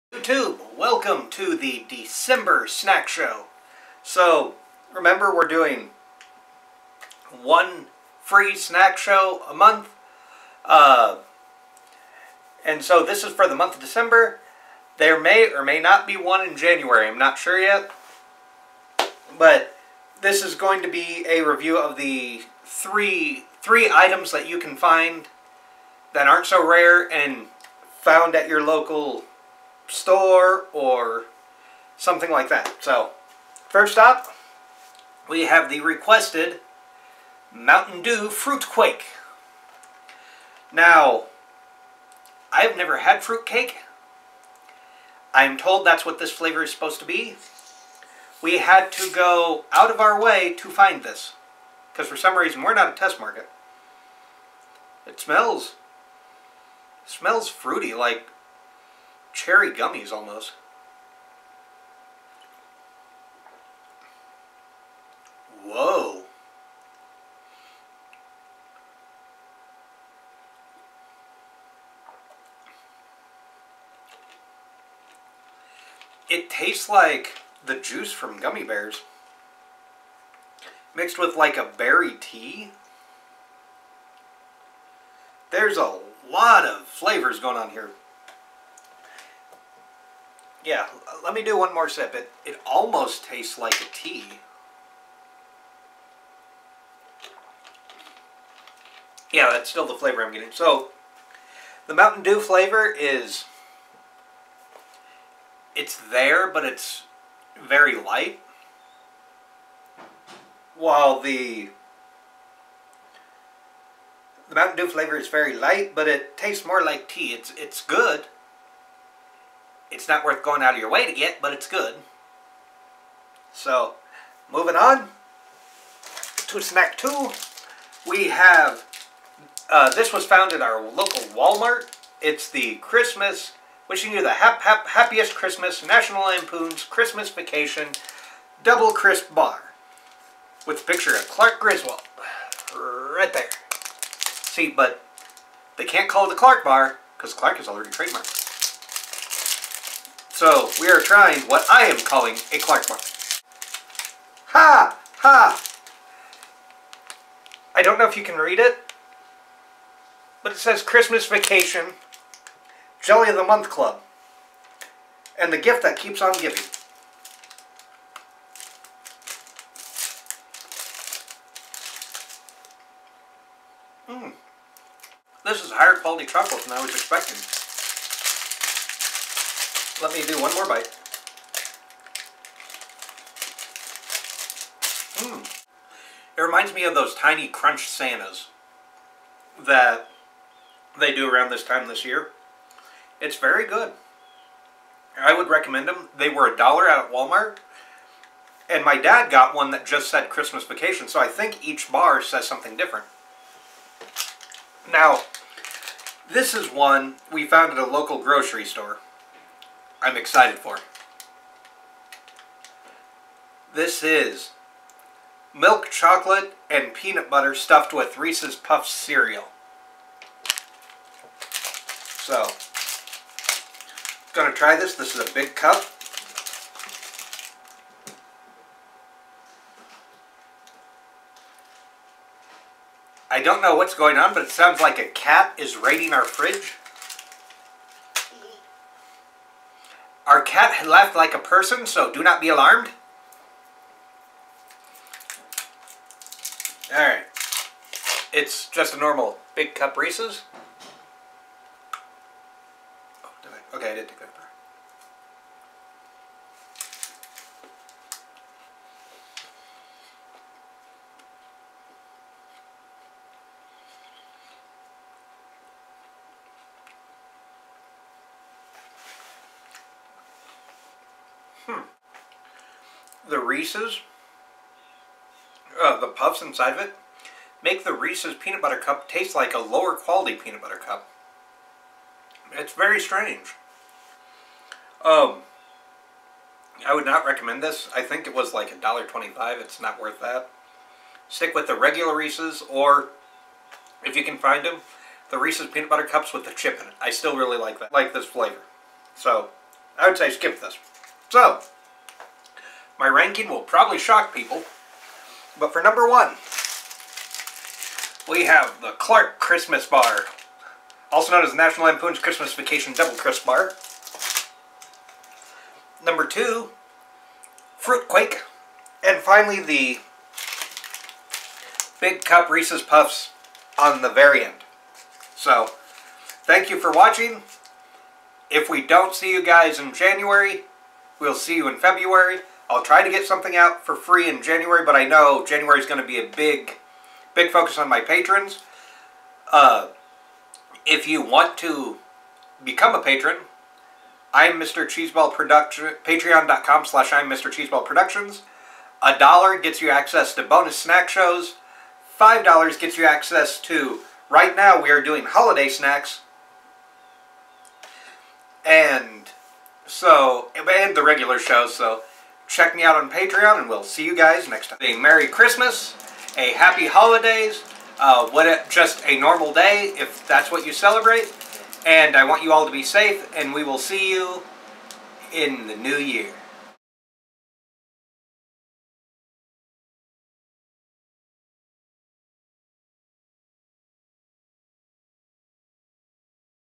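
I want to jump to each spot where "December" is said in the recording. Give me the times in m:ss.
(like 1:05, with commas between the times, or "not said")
0:01, 0:13.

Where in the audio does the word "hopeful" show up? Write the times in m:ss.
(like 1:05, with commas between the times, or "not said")
not said.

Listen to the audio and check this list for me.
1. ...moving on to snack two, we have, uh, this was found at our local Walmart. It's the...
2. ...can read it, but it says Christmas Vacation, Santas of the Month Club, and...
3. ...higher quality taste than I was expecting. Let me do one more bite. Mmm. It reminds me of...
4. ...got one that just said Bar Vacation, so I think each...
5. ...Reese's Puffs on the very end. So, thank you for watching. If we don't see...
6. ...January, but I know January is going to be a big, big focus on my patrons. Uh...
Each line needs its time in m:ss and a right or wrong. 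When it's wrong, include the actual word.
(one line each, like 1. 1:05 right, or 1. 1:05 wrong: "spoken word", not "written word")
1. 2:04 right
2. 2:38 wrong: "Jelly", not "Santas"
3. 2:55 wrong: "chocolate", not "taste"
4. 3:19 wrong: "Christmas", not "Bar"
5. 5:22 right
6. 5:34 right.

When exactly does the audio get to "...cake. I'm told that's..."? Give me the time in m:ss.
0:43.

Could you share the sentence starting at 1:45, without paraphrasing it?
It's there, but it's very light.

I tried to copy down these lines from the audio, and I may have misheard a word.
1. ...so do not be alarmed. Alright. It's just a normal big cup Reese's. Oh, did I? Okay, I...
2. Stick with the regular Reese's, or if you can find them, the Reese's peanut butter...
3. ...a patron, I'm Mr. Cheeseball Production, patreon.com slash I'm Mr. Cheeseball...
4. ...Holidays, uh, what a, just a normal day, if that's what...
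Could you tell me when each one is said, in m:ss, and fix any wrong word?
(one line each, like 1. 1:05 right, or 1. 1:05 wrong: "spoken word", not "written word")
1. 4:01 right
2. 4:51 right
3. 5:42 right
4. 6:06 right.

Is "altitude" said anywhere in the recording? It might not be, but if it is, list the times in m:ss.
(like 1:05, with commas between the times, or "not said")
not said.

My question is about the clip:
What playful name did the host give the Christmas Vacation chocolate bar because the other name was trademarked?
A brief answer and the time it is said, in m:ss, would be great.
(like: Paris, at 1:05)
Clark mark, at 2:32.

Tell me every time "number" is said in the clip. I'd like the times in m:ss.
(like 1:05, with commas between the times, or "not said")
5:05, 5:16.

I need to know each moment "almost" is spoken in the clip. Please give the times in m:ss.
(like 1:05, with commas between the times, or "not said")
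1:00, 1:32.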